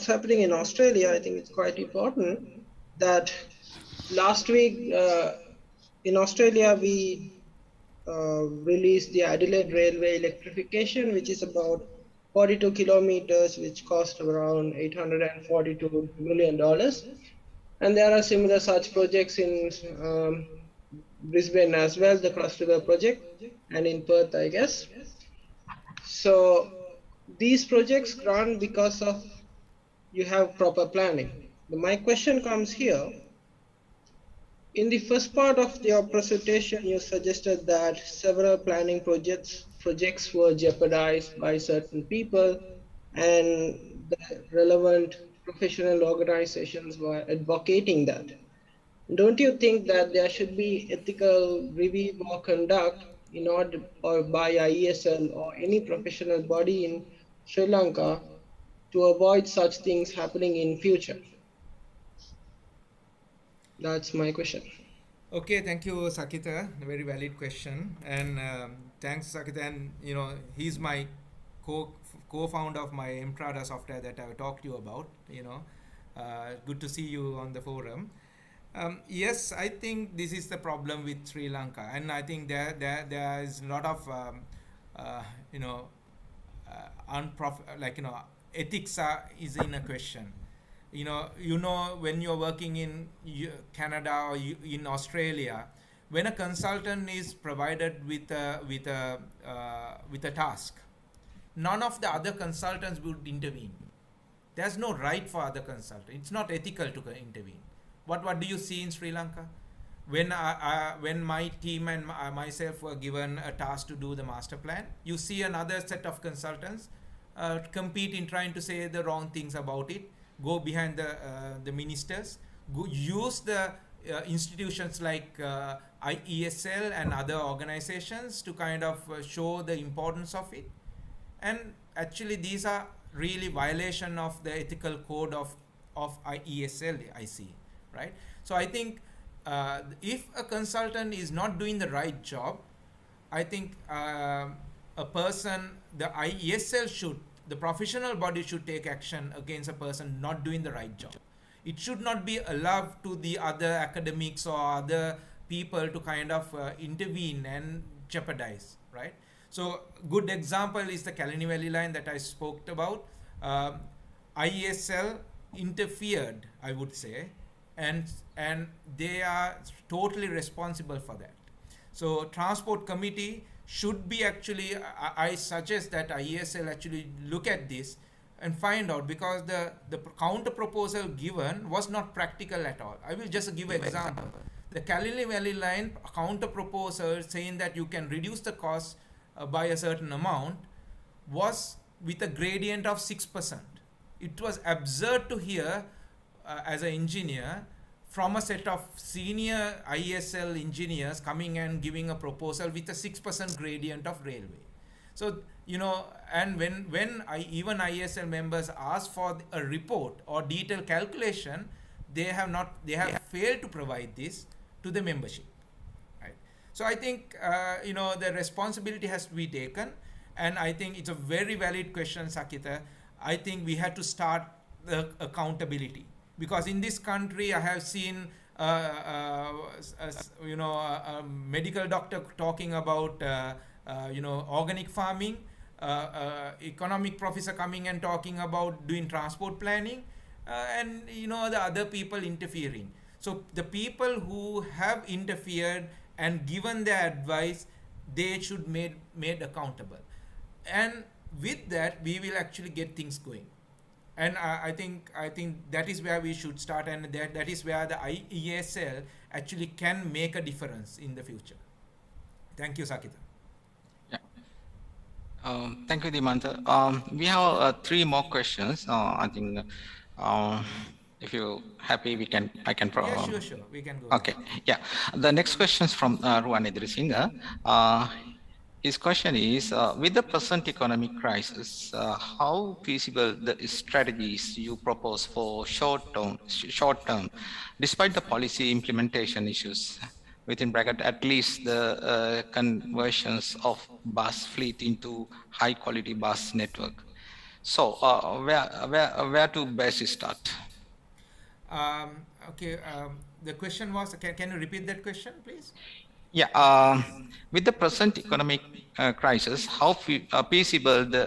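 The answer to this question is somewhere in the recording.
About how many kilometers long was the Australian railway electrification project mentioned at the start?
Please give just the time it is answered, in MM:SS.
00:12.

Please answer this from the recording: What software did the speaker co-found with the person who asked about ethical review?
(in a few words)
Mtrada.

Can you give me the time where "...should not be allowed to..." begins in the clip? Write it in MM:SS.
02:31.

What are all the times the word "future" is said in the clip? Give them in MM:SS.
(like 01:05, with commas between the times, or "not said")
01:00, 04:21.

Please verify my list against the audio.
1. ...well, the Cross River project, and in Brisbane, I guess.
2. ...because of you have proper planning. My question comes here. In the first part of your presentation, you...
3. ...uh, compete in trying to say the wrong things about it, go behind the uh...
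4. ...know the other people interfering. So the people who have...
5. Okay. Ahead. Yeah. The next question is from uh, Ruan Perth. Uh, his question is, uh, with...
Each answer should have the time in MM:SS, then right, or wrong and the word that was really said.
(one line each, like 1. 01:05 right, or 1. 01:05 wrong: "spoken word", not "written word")
1. 00:21 wrong: "Perth", not "Brisbane"
2. 00:28 right
3. 01:57 right
4. 04:01 right
5. 04:34 wrong: "Idrisinga", not "Perth".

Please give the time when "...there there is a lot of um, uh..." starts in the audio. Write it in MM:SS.
01:22.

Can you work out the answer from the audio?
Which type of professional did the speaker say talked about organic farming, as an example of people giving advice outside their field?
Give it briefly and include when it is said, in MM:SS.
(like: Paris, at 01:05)
Medical doctor, at 03:51.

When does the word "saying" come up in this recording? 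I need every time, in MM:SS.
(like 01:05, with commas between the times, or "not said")
03:07.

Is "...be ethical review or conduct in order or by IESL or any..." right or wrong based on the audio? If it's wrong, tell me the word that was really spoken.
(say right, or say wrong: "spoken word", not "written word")
right.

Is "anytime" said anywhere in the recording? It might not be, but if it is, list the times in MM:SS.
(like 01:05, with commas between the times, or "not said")
not said.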